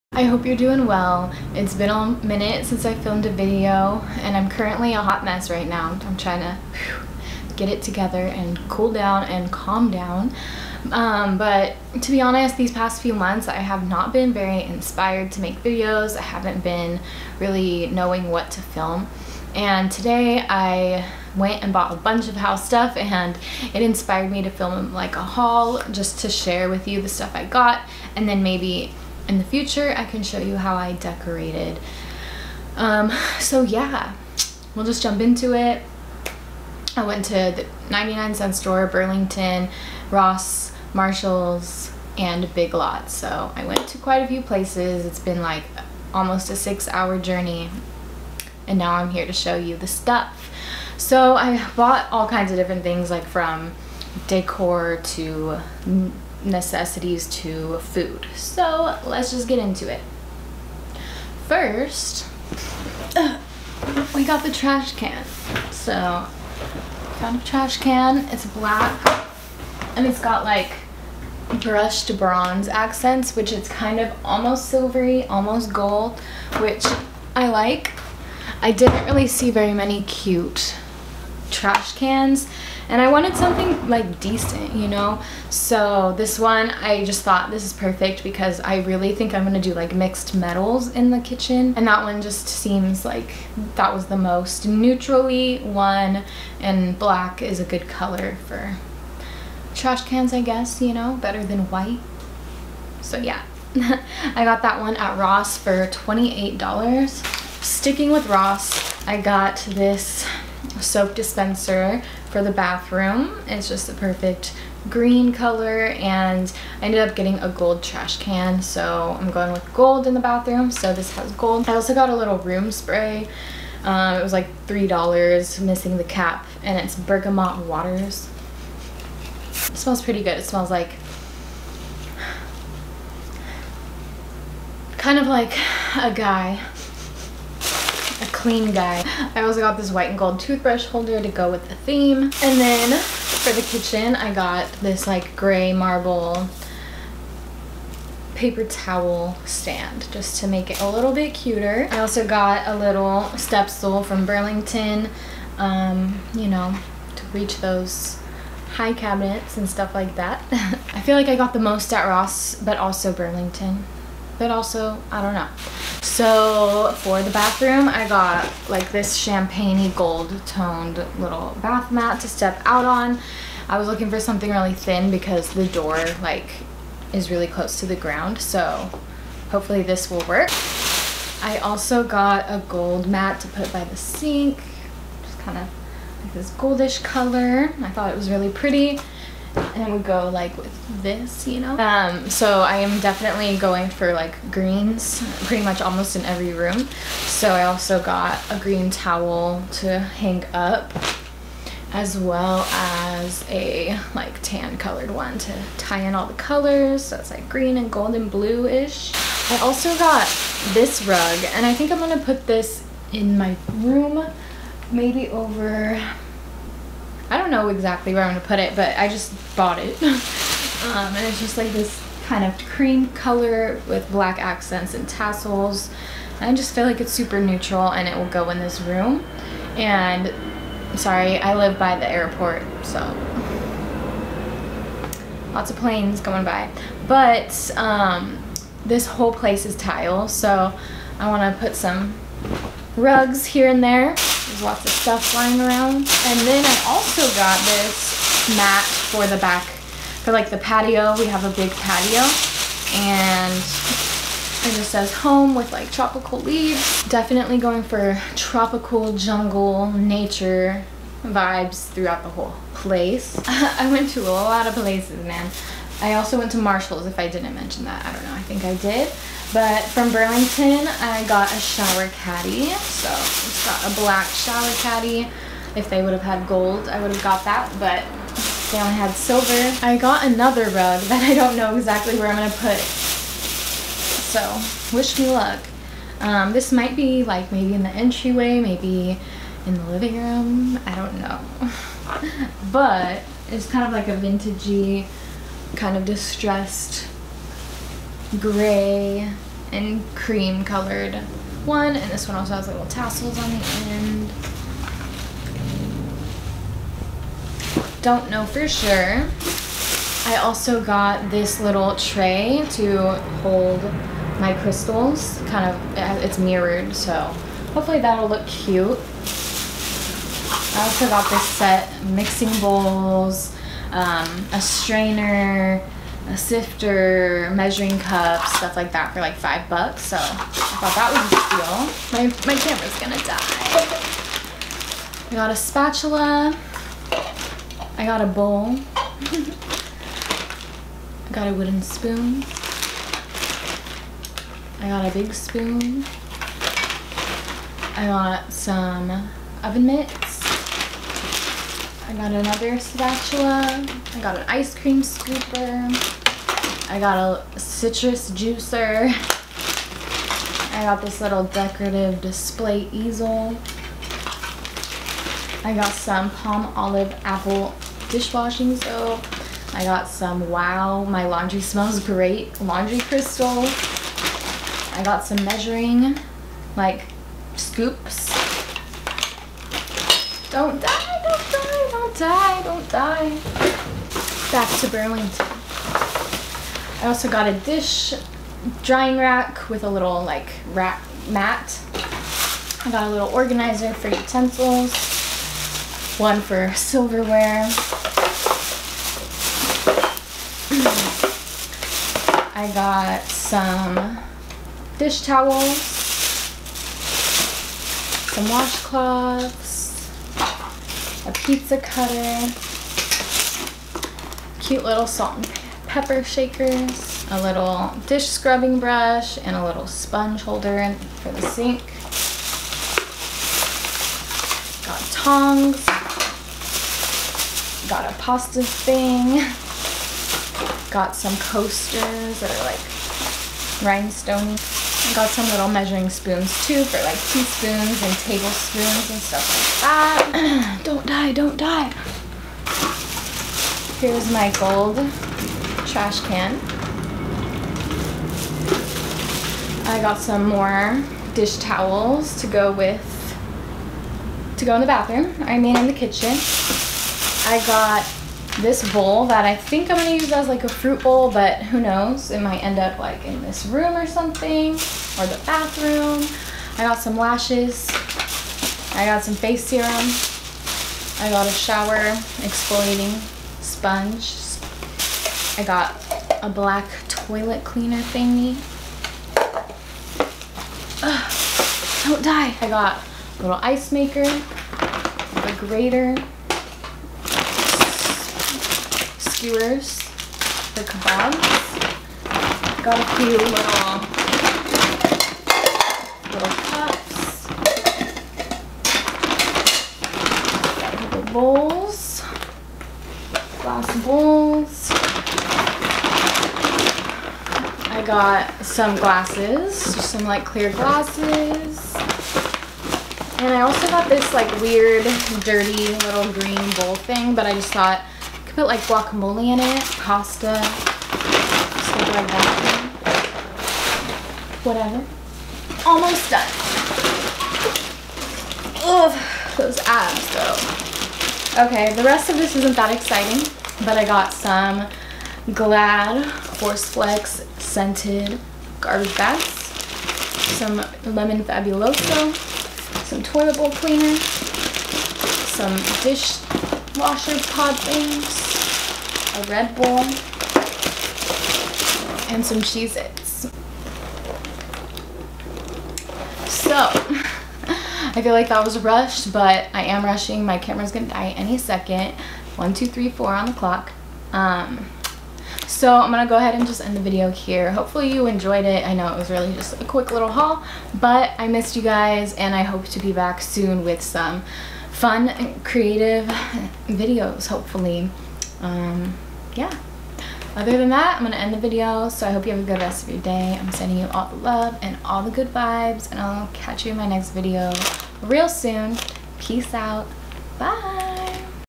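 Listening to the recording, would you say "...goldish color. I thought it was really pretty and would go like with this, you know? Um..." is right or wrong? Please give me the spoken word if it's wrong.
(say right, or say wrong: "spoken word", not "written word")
right.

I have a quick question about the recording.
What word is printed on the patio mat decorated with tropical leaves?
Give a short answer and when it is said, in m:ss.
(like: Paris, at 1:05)
Home, at 4:15.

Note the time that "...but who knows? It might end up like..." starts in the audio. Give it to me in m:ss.
7:41.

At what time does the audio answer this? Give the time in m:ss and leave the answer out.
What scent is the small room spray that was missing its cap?
2:06.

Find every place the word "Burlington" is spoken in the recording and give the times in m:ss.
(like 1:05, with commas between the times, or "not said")
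0:38, 2:34, 2:43, 4:30, 6:24.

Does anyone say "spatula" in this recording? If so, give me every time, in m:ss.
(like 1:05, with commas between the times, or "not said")
5:35, 5:52.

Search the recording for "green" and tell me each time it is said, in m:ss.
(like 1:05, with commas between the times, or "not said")
1:54, 3:14, 3:18, 3:27, 8:36.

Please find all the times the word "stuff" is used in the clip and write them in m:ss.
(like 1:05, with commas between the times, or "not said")
0:22, 0:27, 0:49, 2:39, 4:04, 5:28, 7:19, 8:40.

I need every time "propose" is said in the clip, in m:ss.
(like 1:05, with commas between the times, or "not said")
not said.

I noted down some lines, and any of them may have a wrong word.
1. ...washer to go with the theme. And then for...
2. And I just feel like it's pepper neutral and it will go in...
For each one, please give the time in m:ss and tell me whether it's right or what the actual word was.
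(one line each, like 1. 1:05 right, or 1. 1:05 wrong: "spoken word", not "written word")
1. 2:20 wrong: "holder", not "washer"
2. 3:46 wrong: "super", not "pepper".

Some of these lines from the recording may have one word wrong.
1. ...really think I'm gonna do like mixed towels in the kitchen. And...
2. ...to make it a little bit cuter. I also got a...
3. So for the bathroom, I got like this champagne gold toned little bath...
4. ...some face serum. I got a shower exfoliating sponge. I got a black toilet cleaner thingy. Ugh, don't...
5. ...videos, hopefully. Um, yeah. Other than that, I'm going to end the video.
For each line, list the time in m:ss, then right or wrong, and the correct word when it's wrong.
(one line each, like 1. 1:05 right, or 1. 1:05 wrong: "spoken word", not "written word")
1. 1:28 wrong: "metals", not "towels"
2. 2:30 right
3. 2:46 right
4. 7:49 right
5. 9:36 right.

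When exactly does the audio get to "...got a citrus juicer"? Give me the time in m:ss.
5:56.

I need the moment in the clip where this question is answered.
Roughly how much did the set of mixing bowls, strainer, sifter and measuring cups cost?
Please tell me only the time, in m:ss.
5:29.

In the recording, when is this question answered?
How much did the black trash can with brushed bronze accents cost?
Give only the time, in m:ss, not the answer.
1:45.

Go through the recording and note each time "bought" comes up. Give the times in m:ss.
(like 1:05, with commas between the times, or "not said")
0:21, 0:51, 3:39.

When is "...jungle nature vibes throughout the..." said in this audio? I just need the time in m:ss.
4:19.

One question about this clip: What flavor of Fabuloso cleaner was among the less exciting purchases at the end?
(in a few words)
Lemon.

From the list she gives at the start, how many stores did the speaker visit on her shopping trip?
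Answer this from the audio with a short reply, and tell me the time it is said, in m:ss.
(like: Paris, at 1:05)
5, at 0:37.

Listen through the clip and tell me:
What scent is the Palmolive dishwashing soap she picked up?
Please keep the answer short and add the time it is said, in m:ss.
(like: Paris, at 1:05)
Apple, at 6:07.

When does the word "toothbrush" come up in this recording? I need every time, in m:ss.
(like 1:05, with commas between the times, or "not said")
2:20.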